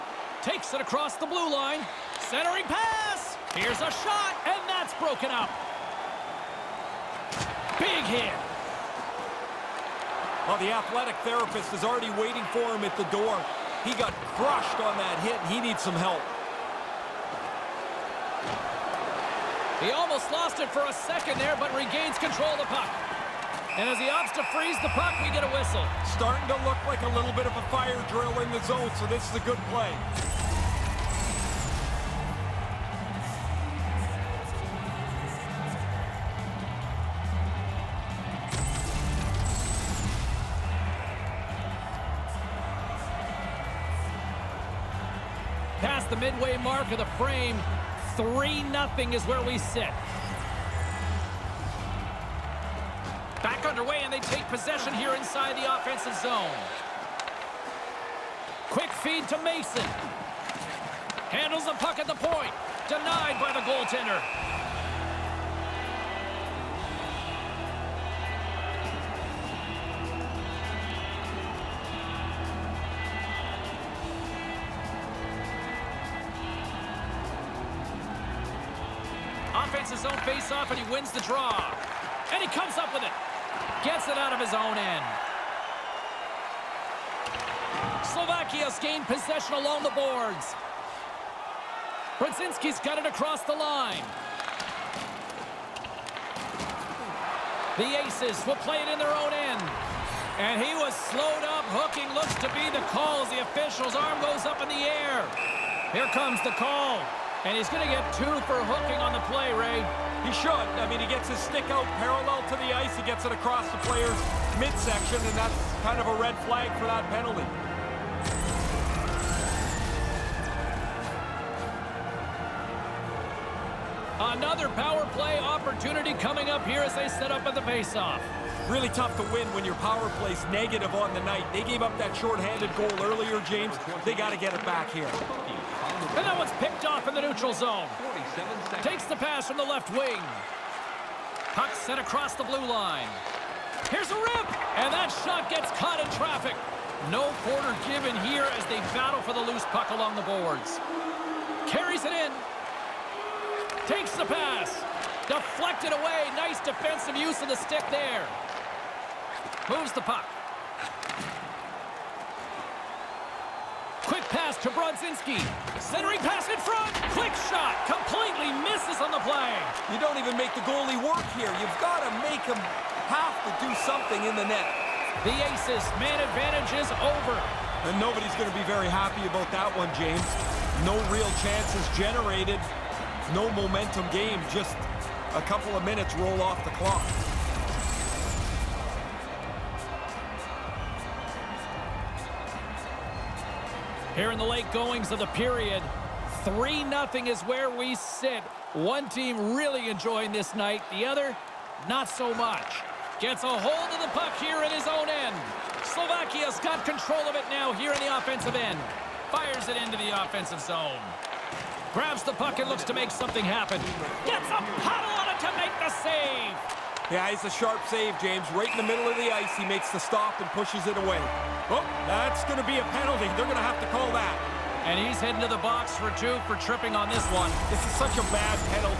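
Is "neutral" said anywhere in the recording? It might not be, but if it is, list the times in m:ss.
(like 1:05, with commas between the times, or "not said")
2:17.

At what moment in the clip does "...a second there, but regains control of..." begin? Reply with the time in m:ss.
0:20.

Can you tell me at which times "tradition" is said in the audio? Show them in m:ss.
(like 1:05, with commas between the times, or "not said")
not said.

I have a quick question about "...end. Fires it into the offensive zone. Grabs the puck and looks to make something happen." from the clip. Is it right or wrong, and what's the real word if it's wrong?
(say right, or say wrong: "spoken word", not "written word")
right.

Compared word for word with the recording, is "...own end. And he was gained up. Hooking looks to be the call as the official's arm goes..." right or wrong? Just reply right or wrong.
wrong.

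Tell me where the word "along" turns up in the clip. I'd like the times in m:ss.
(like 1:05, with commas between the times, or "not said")
1:29, 2:29.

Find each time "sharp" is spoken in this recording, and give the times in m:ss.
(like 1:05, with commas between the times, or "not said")
3:37.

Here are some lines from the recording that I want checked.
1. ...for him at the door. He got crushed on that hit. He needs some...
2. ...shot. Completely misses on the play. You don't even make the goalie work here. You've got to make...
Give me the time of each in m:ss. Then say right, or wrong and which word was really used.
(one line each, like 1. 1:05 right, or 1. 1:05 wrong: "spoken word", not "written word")
1. 0:12 right
2. 2:47 right.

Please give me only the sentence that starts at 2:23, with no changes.
Here's a rip, and that shot gets caught in traffic.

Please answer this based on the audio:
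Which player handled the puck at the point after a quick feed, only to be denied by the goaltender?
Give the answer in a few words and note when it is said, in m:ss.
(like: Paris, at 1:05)
Mason, at 0:59.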